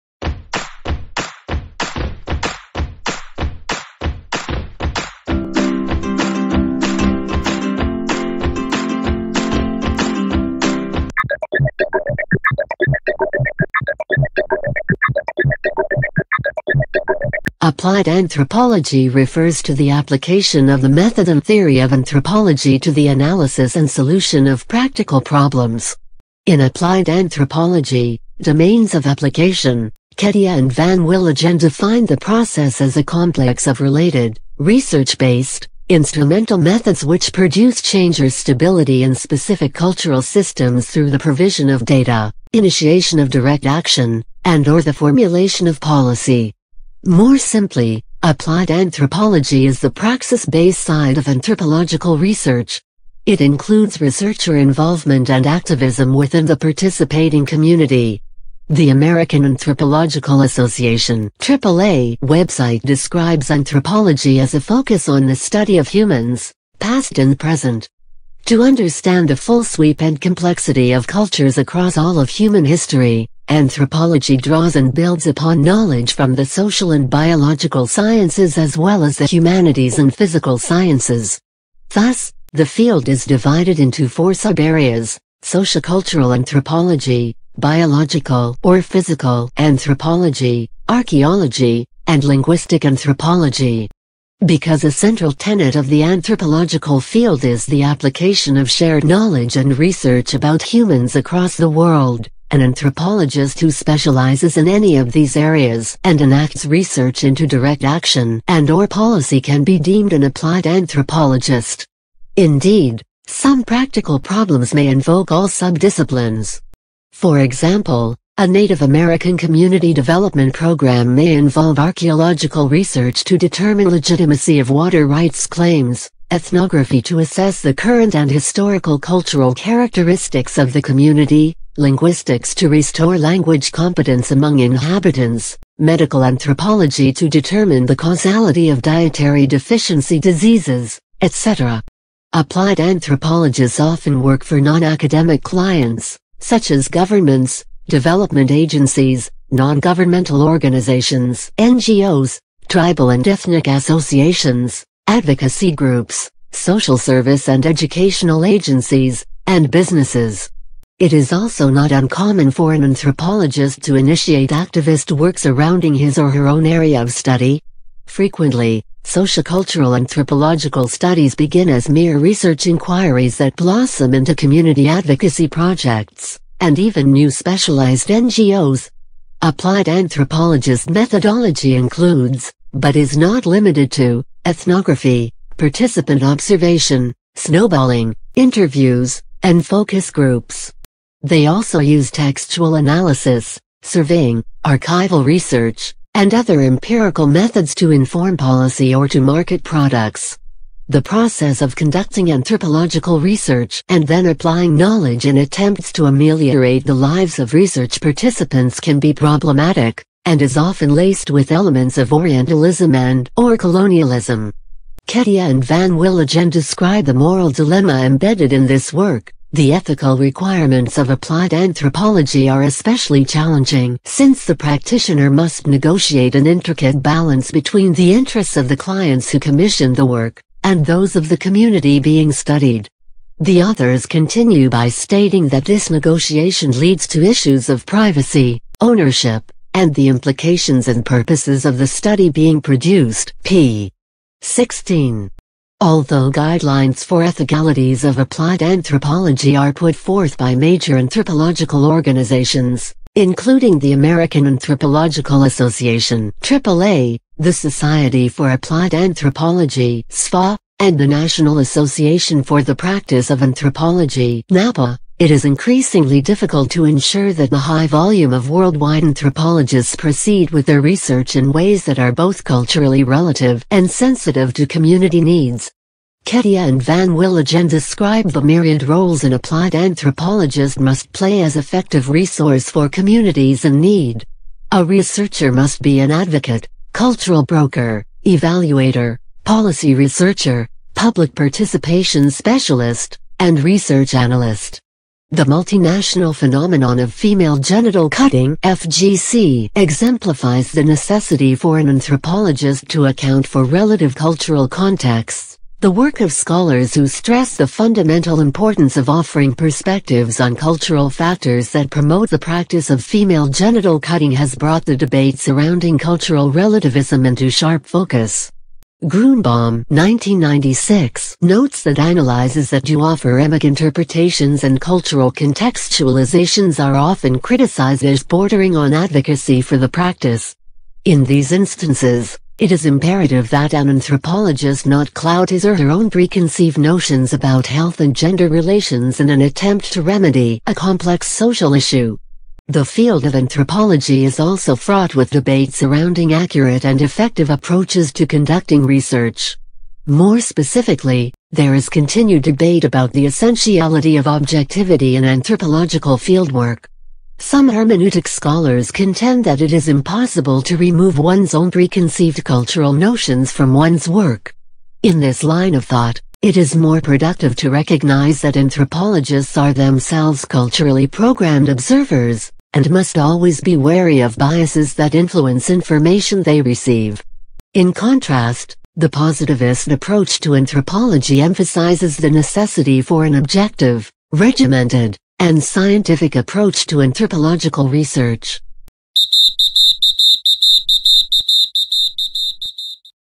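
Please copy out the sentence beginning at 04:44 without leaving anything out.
A researcher must be an advocate, cultural broker, evaluator, policy researcher, public participation specialist, and research analyst.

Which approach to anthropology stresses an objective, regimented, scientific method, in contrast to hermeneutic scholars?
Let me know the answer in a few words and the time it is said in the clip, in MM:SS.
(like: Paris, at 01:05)
positivist approach, at 06:19.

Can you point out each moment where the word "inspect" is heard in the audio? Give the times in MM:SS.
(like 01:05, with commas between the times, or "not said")
not said.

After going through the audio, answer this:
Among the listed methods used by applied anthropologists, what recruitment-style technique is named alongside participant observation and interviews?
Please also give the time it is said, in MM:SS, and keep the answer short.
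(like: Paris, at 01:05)
snowballing, at 03:07.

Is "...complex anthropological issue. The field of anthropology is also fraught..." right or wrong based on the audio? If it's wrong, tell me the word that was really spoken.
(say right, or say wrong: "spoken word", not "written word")
wrong: "social", not "anthropological".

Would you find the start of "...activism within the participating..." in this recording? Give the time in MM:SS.
00:55.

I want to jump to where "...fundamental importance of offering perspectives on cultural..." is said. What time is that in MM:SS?
05:07.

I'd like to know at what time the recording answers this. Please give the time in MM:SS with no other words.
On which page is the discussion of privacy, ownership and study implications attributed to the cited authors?
04:03.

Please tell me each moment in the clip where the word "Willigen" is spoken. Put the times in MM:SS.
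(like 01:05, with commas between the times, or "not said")
00:30, 03:35, 04:37.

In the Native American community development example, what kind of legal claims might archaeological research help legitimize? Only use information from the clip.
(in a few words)
water rights claims.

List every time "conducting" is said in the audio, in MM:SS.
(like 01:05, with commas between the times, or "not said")
03:21, 05:48.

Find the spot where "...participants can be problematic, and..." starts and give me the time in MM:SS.
03:28.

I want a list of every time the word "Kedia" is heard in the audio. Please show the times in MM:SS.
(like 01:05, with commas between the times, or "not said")
00:30, 03:35, 04:36.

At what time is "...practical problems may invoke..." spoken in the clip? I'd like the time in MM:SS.
01:53.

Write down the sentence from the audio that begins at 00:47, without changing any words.
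More simply, applied anthropology is the praxis-based side of anthropological research.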